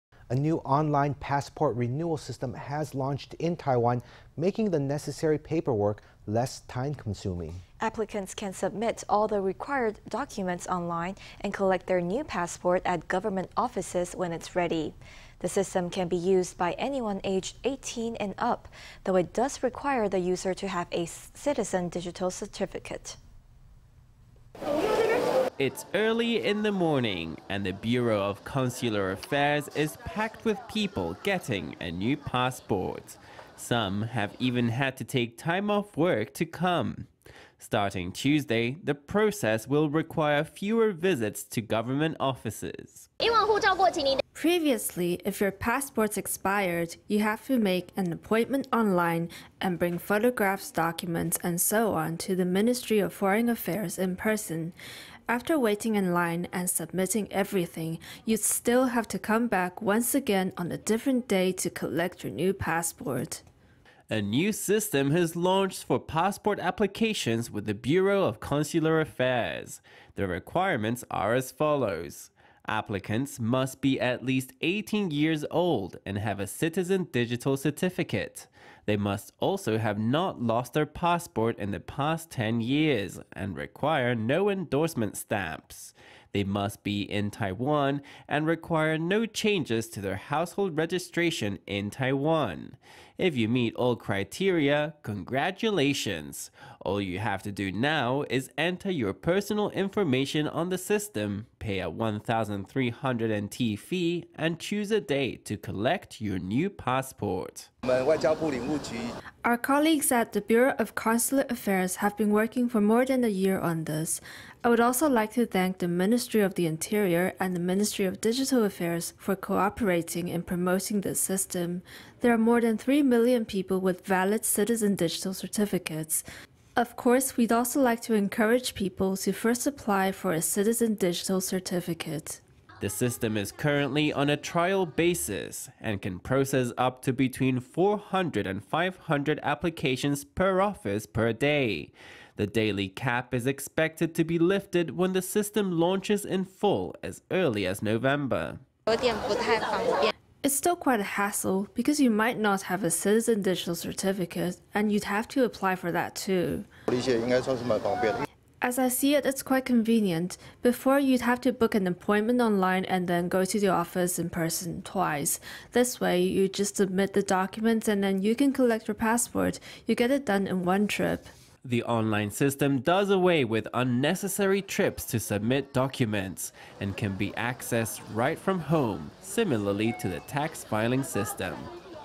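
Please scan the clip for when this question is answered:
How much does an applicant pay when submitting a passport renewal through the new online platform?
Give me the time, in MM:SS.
01:41.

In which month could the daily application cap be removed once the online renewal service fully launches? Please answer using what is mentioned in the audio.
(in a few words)
November.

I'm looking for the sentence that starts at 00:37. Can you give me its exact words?
Starting Tuesday, the process will require fewer visits to government offices.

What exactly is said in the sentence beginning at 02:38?
As I see it, it's quite convenient.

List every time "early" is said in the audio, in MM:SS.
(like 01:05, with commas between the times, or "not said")
00:25, 02:27.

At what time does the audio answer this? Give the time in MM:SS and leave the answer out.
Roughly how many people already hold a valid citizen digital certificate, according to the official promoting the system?
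02:02.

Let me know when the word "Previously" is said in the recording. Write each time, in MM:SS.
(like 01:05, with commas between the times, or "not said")
00:44.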